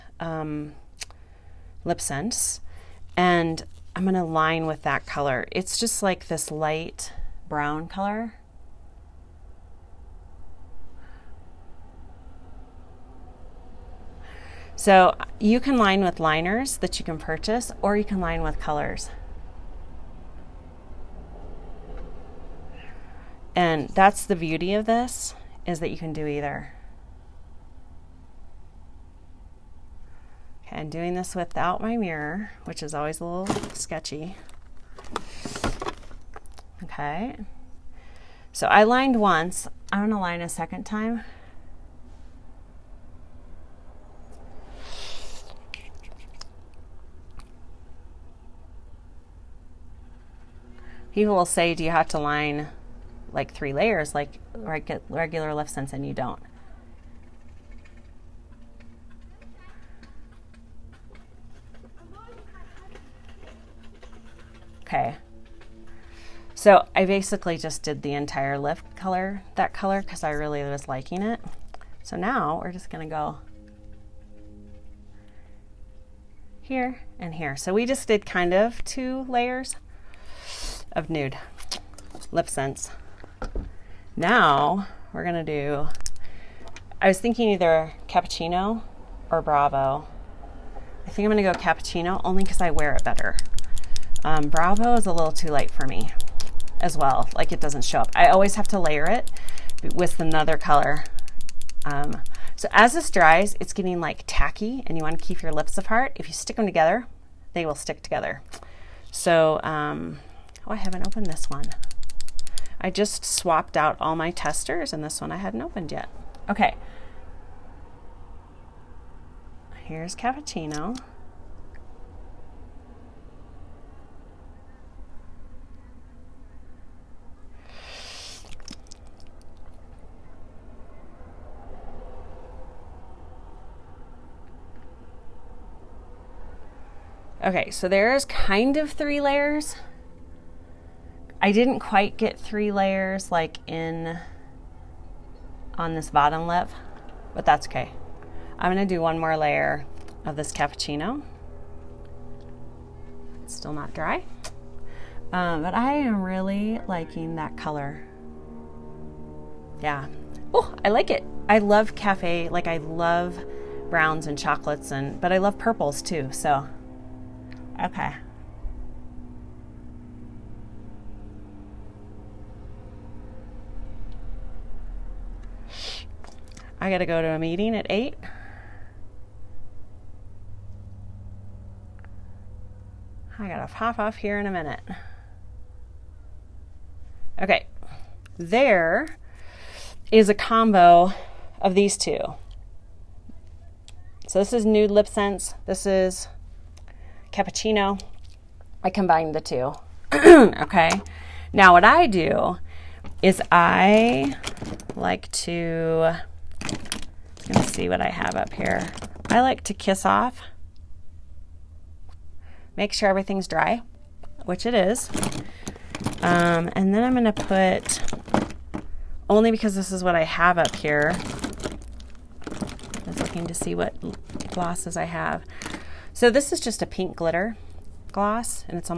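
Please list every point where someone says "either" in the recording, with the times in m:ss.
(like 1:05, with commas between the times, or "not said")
0:26, 1:27.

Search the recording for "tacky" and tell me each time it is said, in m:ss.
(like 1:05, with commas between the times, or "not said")
1:44.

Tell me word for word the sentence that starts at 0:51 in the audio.
people will say, do you have to line like three layers like regular Lip Sense and you don't.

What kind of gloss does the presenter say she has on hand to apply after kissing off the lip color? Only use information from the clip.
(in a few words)
pink glitter gloss.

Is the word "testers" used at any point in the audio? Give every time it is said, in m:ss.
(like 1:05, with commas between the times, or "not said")
1:54.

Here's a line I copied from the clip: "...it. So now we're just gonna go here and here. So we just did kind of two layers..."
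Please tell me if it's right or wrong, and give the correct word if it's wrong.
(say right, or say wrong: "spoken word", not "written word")
right.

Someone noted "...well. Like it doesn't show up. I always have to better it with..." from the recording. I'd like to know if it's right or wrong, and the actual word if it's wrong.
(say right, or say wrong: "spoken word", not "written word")
wrong: "layer", not "better".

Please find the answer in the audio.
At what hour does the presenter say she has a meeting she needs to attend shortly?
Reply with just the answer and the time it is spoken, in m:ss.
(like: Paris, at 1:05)
8, at 2:57.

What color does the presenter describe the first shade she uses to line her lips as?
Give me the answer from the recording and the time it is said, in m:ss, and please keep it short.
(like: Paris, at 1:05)
light brown, at 0:06.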